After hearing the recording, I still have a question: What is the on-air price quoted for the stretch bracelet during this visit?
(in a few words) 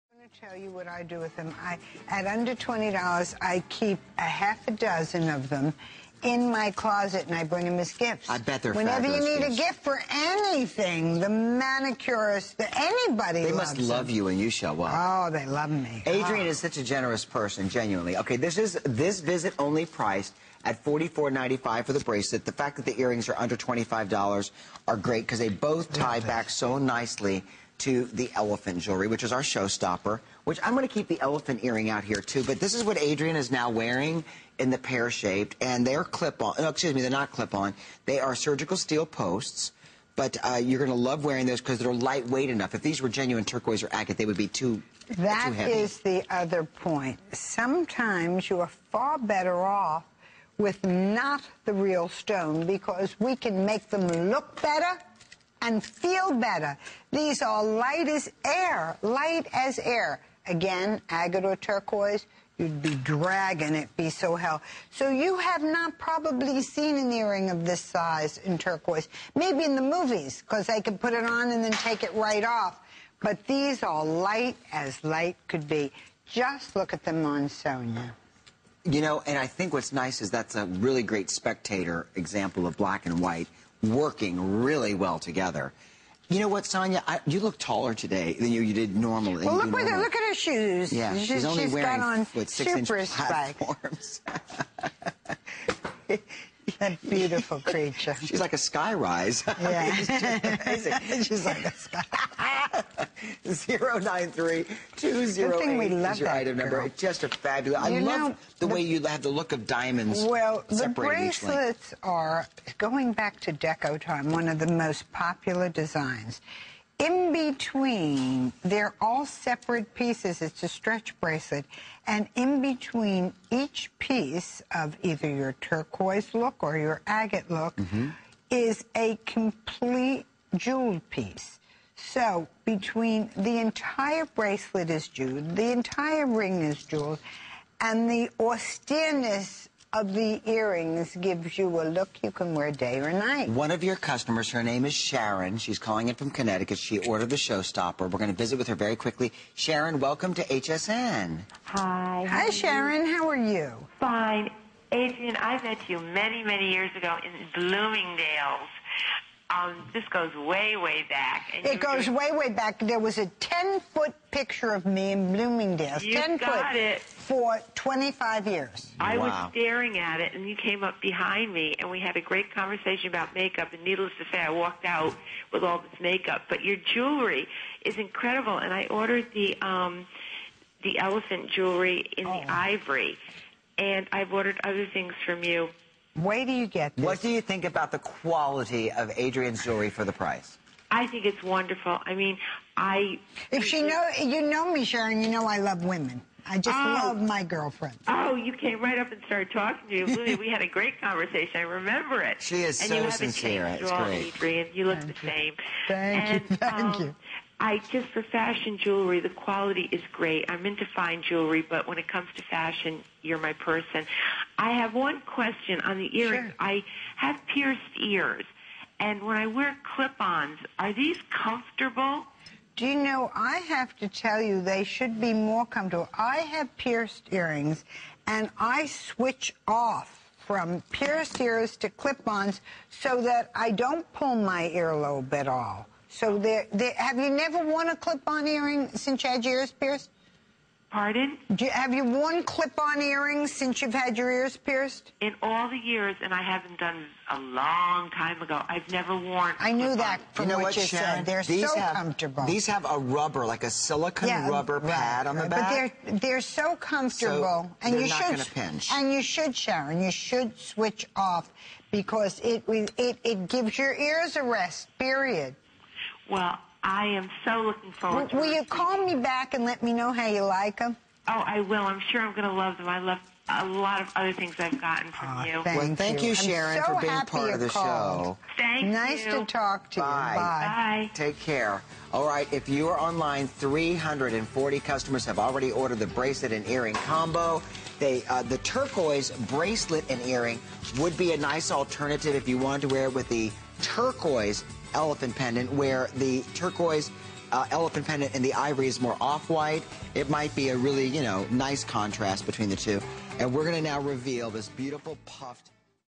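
$44.95.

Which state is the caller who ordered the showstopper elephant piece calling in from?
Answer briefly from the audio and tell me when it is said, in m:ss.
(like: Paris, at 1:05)
Connecticut, at 2:26.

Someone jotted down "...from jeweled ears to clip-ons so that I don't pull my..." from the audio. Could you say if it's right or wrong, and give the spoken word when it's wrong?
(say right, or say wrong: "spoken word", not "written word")
wrong: "pierced", not "jeweled".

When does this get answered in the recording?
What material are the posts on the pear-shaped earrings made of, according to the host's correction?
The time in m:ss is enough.
0:38.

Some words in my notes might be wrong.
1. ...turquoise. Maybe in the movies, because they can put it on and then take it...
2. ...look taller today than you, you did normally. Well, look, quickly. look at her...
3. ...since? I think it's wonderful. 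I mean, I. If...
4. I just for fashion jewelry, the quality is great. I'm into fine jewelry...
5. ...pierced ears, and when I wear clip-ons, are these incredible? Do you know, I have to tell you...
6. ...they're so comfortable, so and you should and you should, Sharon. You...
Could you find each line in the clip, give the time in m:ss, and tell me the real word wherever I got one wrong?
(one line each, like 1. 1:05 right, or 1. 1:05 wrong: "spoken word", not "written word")
1. 1:08 right
2. 1:27 wrong: "normally", not "quickly"
3. 3:10 wrong: "price", not "since"
4. 3:27 right
5. 3:37 wrong: "comfortable", not "incredible"
6. 4:16 right.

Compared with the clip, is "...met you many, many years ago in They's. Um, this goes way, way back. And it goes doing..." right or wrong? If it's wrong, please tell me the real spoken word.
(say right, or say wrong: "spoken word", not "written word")
wrong: "Bloomingdale", not "They".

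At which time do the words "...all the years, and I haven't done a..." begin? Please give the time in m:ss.
4:05.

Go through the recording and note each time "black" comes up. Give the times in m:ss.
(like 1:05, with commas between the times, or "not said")
1:22.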